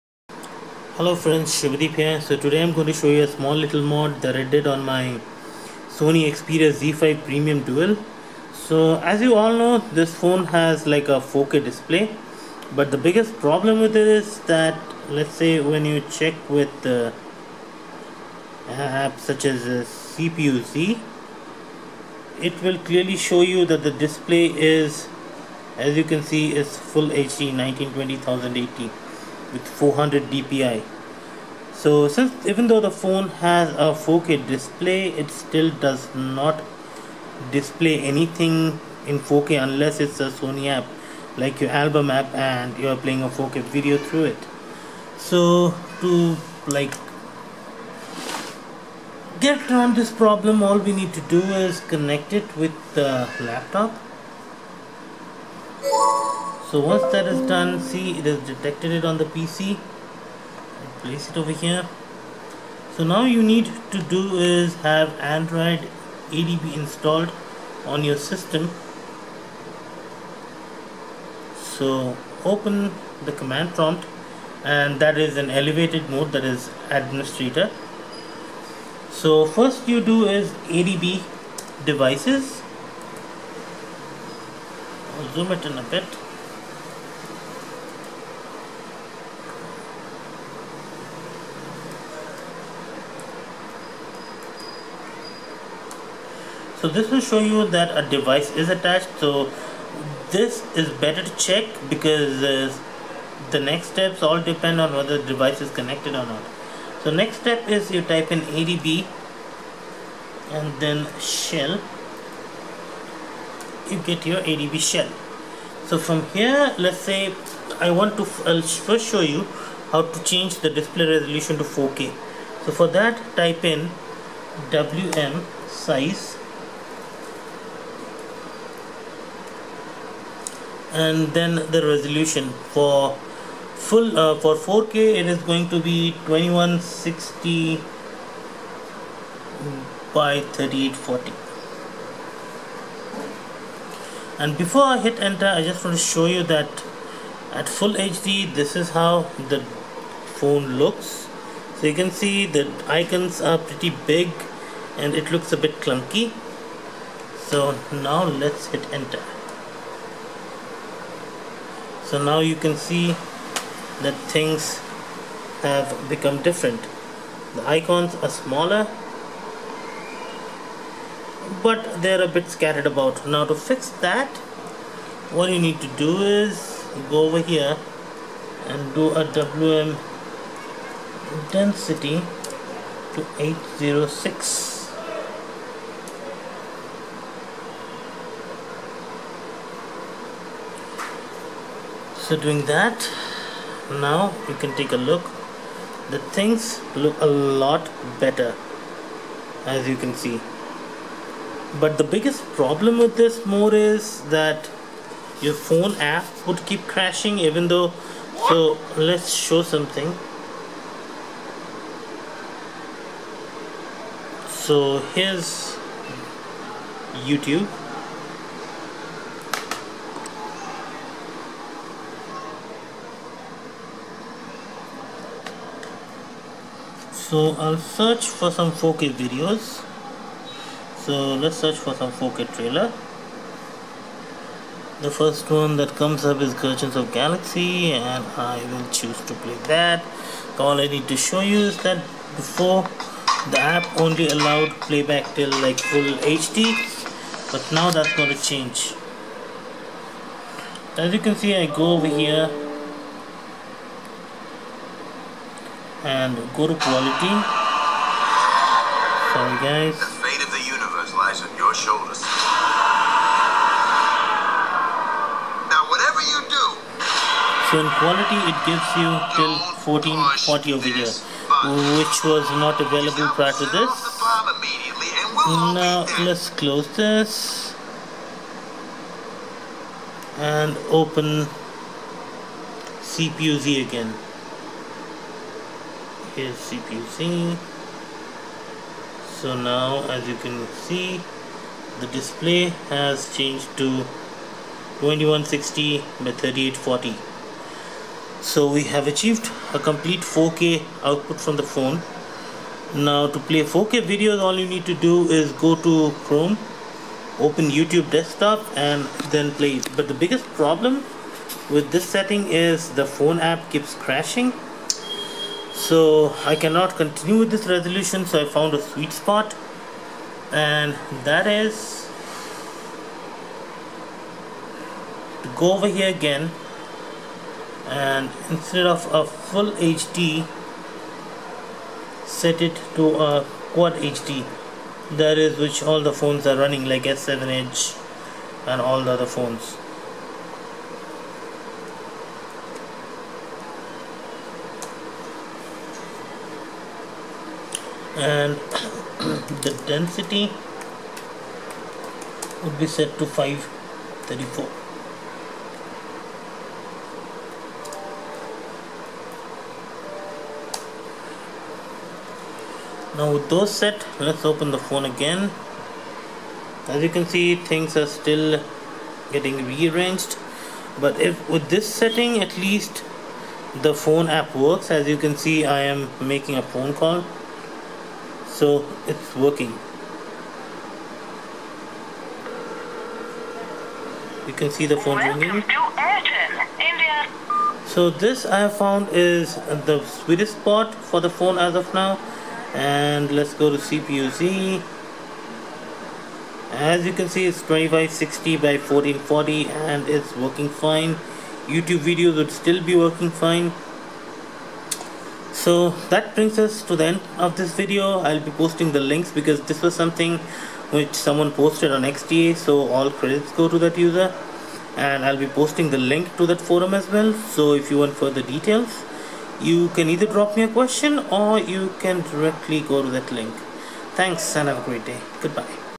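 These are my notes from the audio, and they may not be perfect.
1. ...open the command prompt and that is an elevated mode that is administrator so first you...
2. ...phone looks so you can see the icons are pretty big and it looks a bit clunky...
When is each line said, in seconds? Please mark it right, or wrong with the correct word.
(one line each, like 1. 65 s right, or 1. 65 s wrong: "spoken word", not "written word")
1. 72 s right
2. 150 s right.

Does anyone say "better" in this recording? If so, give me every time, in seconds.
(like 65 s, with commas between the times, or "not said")
101 s, 198 s.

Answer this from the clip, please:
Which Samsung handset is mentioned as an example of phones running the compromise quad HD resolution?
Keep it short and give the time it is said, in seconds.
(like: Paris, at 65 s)
S7 Edge, at 337 s.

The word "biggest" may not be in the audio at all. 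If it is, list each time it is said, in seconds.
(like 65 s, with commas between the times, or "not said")
12 s, 202 s, 310 s.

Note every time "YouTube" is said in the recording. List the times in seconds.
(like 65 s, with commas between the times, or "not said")
217 s, 307 s, 401 s.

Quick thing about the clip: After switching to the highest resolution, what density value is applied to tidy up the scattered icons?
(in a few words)
806.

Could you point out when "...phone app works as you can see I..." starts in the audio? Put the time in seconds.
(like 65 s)
373 s.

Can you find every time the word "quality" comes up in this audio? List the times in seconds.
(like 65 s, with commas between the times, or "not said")
256 s, 267 s.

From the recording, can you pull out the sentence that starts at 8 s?
So as you all know, this phone has like a 4K display.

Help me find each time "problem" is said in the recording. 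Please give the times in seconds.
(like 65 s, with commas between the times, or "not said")
13 s, 50 s, 202 s, 310 s.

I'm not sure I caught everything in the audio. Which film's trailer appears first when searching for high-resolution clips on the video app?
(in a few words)
Guardians of Galaxy.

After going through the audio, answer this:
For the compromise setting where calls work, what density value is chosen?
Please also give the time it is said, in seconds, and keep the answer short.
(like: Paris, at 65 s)
534, at 353 s.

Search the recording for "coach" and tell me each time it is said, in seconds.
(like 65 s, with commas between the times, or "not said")
not said.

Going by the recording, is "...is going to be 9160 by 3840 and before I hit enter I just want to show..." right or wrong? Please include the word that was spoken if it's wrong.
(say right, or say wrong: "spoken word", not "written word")
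wrong: "2160", not "9160".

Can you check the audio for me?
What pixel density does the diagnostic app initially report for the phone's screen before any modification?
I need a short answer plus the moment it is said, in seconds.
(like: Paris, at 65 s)
400 dpi, at 29 s.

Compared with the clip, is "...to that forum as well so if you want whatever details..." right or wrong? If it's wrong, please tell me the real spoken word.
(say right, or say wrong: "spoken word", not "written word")
wrong: "further", not "whatever".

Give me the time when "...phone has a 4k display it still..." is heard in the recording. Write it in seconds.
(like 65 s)
32 s.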